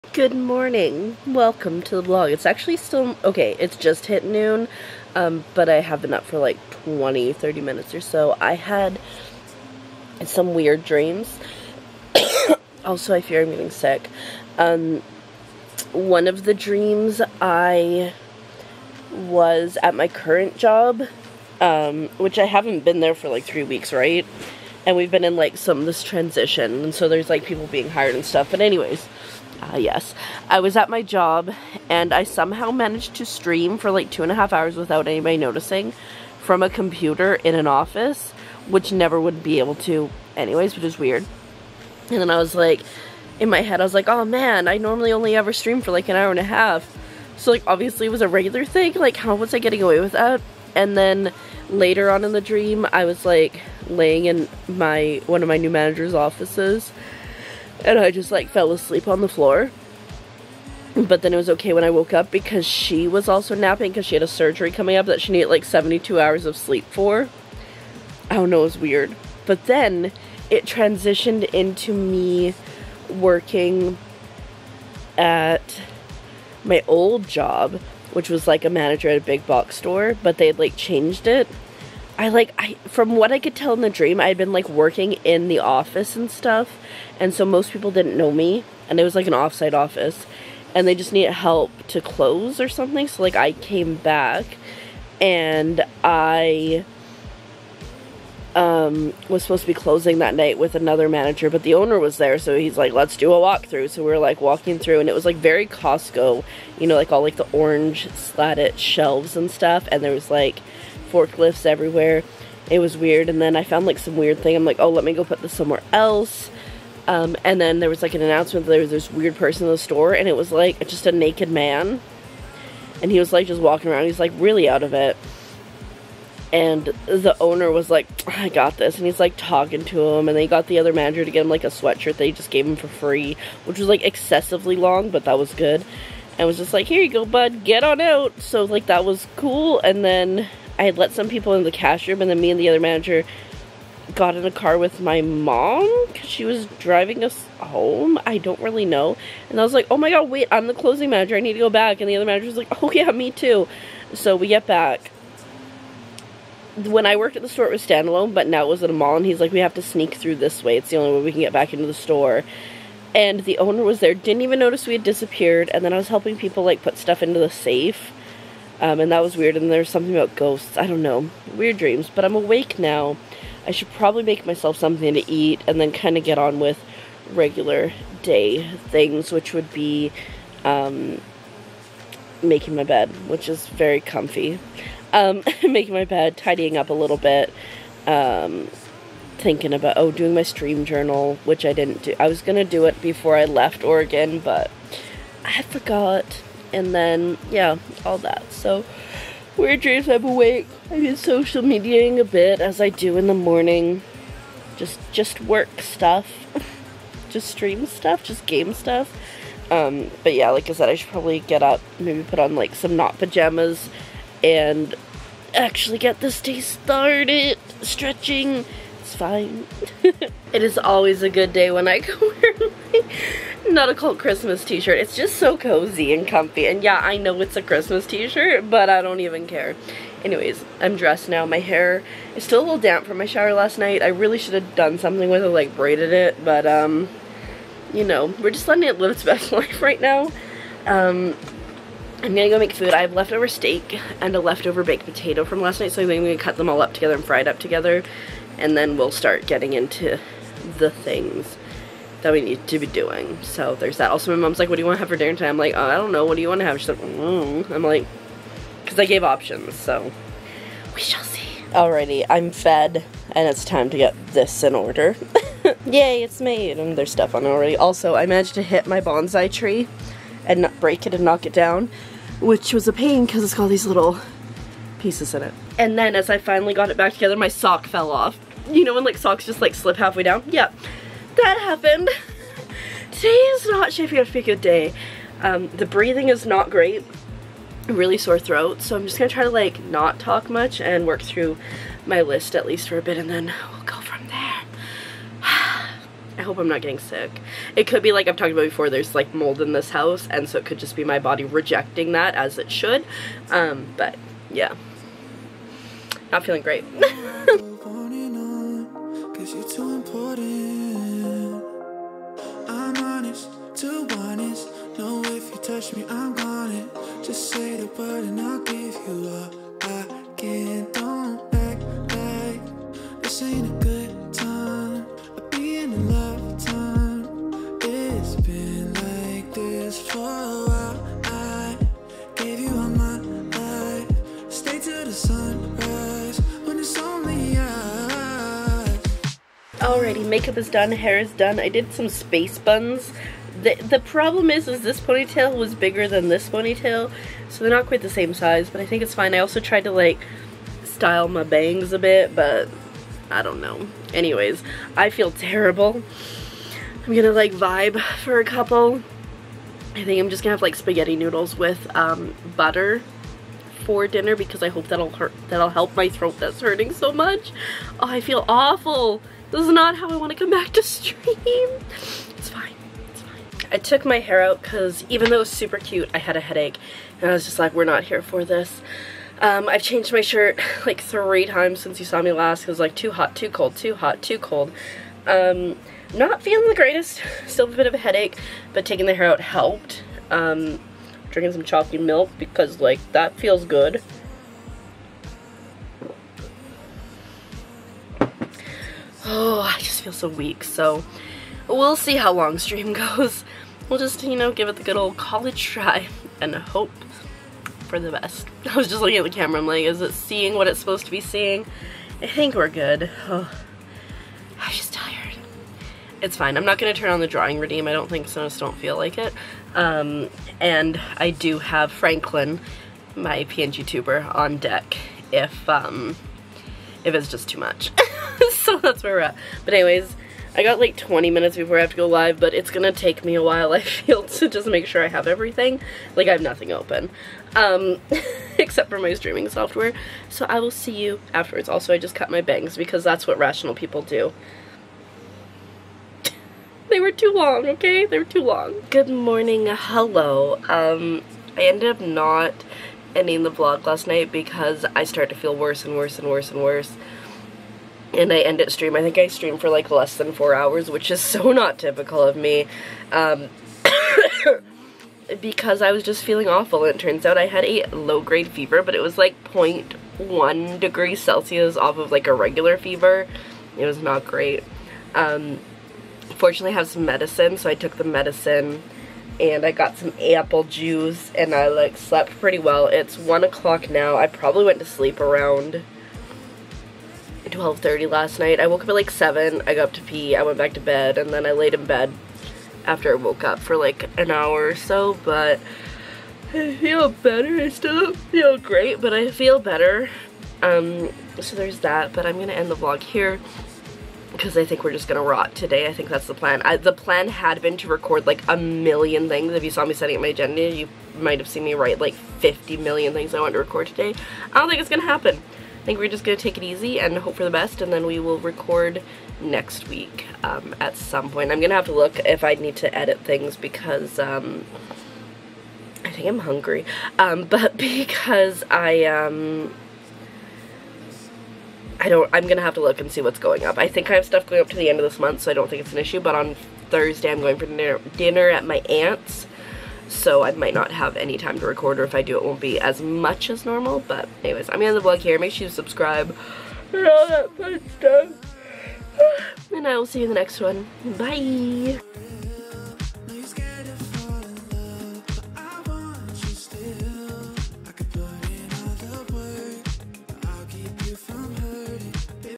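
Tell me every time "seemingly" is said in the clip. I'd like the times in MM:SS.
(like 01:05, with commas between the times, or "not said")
not said.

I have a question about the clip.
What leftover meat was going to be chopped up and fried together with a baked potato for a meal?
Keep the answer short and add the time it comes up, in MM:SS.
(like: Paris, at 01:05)
steak, at 04:03.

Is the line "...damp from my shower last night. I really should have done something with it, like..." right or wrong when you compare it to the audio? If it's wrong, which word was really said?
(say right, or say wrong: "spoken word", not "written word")
right.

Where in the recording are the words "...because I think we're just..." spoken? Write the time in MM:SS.
08:24.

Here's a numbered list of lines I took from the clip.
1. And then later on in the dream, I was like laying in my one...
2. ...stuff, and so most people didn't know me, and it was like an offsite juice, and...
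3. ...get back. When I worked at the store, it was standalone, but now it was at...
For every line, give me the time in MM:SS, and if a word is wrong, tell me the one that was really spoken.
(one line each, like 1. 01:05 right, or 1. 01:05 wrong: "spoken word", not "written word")
1. 00:50 right
2. 01:26 wrong: "office", not "juice"
3. 02:34 right.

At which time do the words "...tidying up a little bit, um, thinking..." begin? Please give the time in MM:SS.
03:06.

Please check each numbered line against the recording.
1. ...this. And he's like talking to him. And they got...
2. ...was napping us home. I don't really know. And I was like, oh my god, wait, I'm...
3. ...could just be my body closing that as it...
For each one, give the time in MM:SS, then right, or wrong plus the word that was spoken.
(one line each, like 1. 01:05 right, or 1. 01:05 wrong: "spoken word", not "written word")
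1. 02:08 right
2. 02:26 wrong: "driving", not "napping"
3. 05:00 wrong: "rejecting", not "closing".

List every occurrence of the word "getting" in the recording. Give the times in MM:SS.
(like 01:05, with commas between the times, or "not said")
00:13, 00:49, 04:09, 04:56.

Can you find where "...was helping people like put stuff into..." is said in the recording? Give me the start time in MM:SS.
02:45.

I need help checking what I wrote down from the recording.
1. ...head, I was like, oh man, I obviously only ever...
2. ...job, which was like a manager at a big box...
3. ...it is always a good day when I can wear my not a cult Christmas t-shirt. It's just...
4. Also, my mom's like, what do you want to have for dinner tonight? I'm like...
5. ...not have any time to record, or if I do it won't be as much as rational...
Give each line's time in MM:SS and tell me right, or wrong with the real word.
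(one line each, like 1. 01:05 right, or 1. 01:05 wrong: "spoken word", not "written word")
1. 00:43 wrong: "normally", not "obviously"
2. 01:17 right
3. 03:40 right
4. 04:14 right
5. 09:00 wrong: "normal", not "rational".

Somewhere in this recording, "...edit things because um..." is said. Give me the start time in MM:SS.
08:42.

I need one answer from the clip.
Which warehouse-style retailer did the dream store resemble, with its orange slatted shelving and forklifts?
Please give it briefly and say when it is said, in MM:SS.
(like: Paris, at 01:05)
Costco, at 01:45.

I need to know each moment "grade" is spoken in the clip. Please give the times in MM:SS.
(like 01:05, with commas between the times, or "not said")
07:47.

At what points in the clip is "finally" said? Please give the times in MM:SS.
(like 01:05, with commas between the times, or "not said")
04:36.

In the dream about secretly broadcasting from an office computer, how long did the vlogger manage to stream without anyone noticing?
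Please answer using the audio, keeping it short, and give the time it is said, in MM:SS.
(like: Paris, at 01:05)
two and a half hours, at 00:34.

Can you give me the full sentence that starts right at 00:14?
Um, one of the dreams, I was at my current job, um, which I haven't been there for like three weeks, right?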